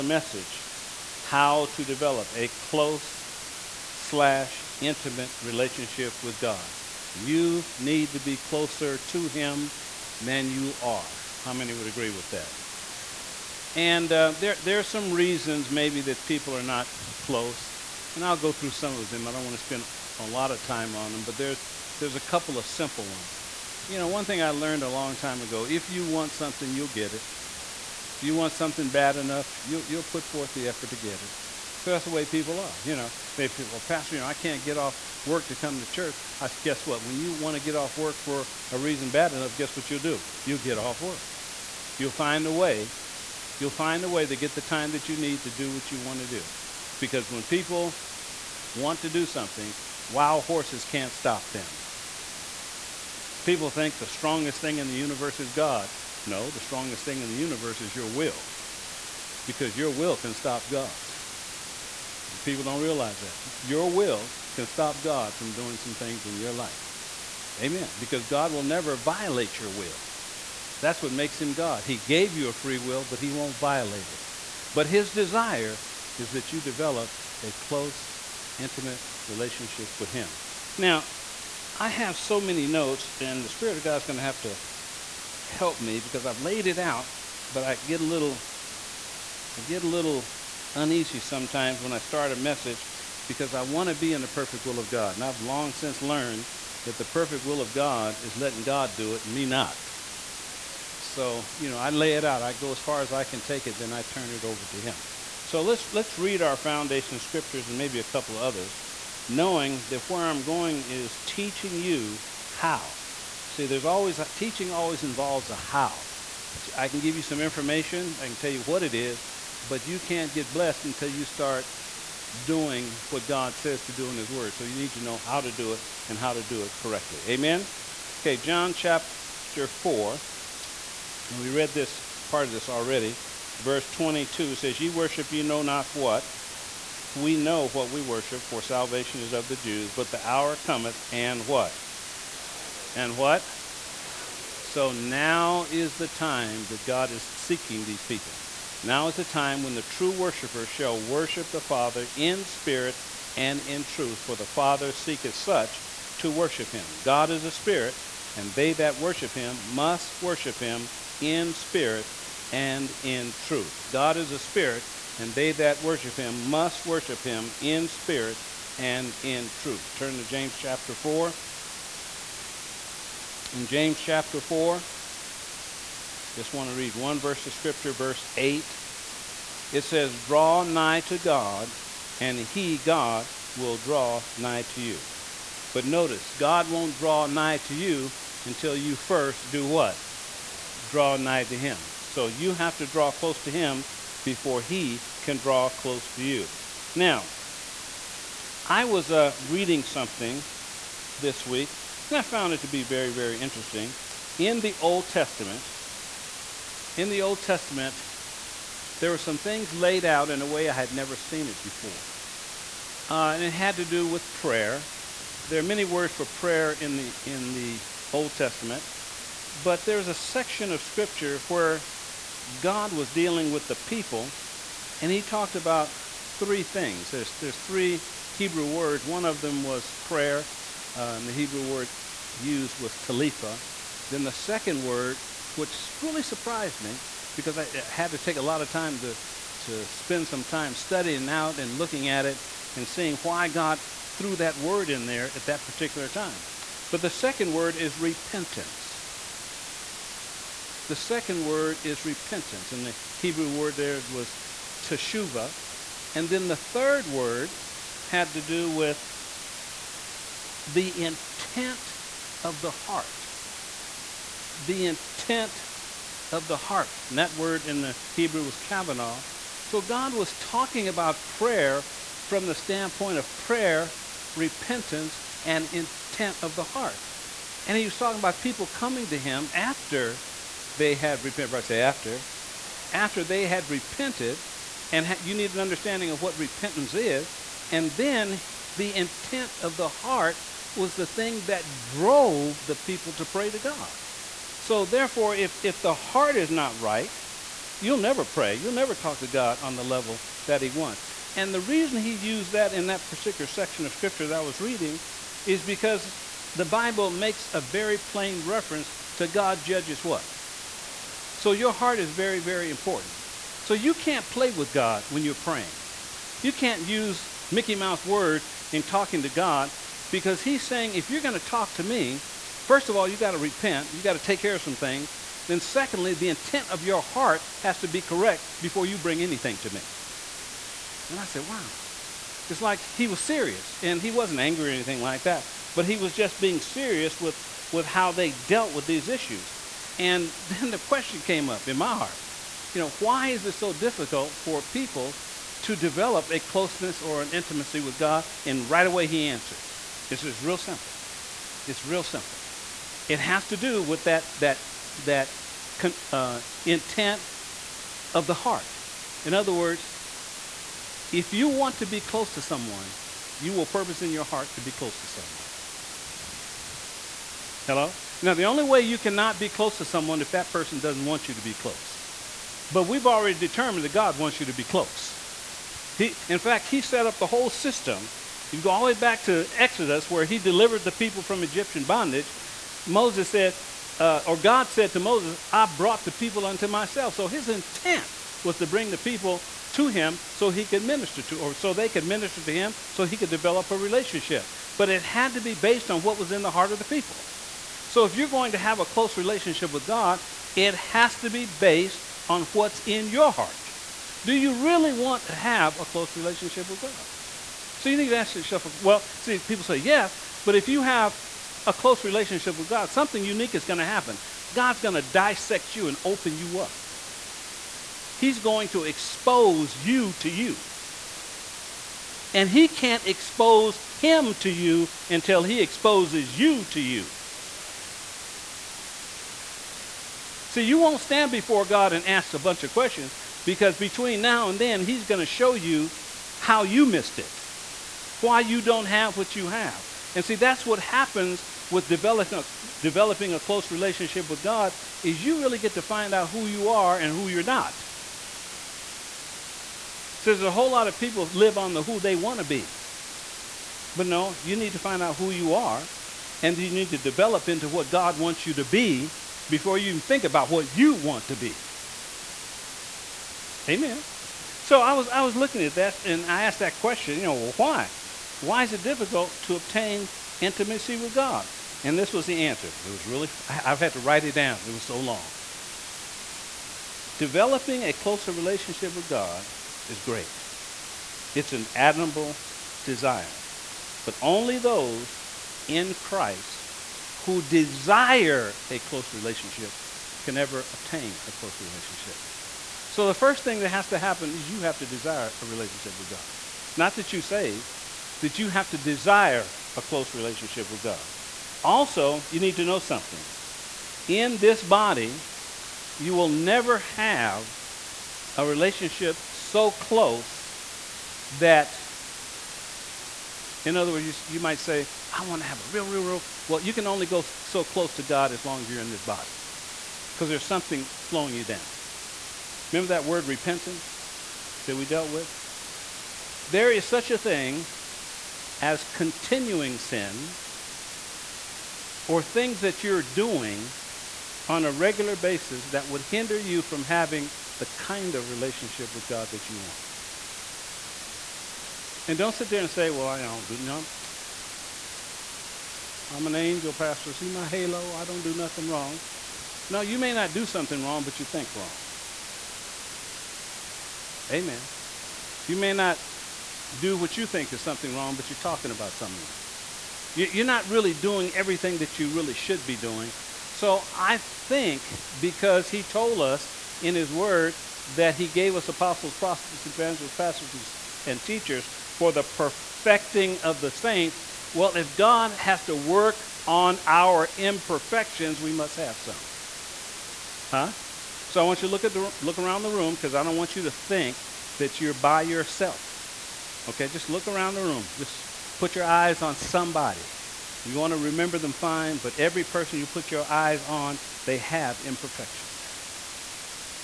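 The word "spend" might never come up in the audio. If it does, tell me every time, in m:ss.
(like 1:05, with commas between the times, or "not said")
0:19, 3:59.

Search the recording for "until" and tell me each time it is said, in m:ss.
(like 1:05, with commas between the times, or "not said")
2:00, 3:08, 7:05.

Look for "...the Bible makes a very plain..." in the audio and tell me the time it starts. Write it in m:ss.
5:06.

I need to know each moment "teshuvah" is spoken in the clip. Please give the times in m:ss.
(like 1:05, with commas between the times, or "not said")
4:14.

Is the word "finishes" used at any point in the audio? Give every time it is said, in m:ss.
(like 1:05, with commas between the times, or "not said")
not said.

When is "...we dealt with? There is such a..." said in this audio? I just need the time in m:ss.
8:44.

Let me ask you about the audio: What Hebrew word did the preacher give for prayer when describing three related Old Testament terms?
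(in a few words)
talifa.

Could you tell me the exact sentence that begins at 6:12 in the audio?
But we've already determined that God wants you to be close.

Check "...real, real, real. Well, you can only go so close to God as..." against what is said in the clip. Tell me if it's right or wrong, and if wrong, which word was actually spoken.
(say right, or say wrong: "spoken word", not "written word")
right.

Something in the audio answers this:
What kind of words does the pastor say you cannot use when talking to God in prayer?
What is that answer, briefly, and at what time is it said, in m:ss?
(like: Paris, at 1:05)
Mickey Mouse words, at 5:17.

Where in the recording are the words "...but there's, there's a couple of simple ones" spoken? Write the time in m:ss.
0:21.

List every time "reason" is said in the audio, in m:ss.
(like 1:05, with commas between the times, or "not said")
0:15, 0:38, 5:01.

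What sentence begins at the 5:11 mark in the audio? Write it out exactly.
So, your heart is very, very important.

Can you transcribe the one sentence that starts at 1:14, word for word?
But his desire is that you develop a close, intimate relationship with him.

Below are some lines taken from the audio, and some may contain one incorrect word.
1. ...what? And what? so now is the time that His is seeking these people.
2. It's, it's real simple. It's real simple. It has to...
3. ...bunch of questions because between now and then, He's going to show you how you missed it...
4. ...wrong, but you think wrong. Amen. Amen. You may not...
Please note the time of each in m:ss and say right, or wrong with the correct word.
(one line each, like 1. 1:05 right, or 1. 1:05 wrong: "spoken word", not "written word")
1. 2:21 wrong: "God", not "His"
2. 5:50 right
3. 7:12 right
4. 9:10 right.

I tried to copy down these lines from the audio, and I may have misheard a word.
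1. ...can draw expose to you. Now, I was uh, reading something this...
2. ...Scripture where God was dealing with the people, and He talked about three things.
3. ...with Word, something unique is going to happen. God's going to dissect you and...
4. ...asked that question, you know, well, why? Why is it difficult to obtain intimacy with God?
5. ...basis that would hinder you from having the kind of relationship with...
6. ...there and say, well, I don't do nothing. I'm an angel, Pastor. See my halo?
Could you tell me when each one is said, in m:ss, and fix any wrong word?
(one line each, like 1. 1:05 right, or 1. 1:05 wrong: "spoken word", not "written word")
1. 3:15 wrong: "close", not "expose"
2. 3:40 right
3. 6:52 wrong: "God", not "Word"
4. 7:46 right
5. 8:55 right
6. 9:02 right.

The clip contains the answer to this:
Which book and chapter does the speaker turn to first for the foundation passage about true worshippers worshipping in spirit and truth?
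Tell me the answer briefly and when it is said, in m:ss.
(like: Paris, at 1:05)
John chapter 4, at 2:08.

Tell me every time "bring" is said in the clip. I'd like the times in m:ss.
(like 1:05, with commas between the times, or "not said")
5:28, 6:28.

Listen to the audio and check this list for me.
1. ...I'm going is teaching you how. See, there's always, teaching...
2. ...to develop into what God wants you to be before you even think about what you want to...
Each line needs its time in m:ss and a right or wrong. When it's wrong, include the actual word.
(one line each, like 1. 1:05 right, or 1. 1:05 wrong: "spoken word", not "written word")
1. 1:50 right
2. 7:36 right.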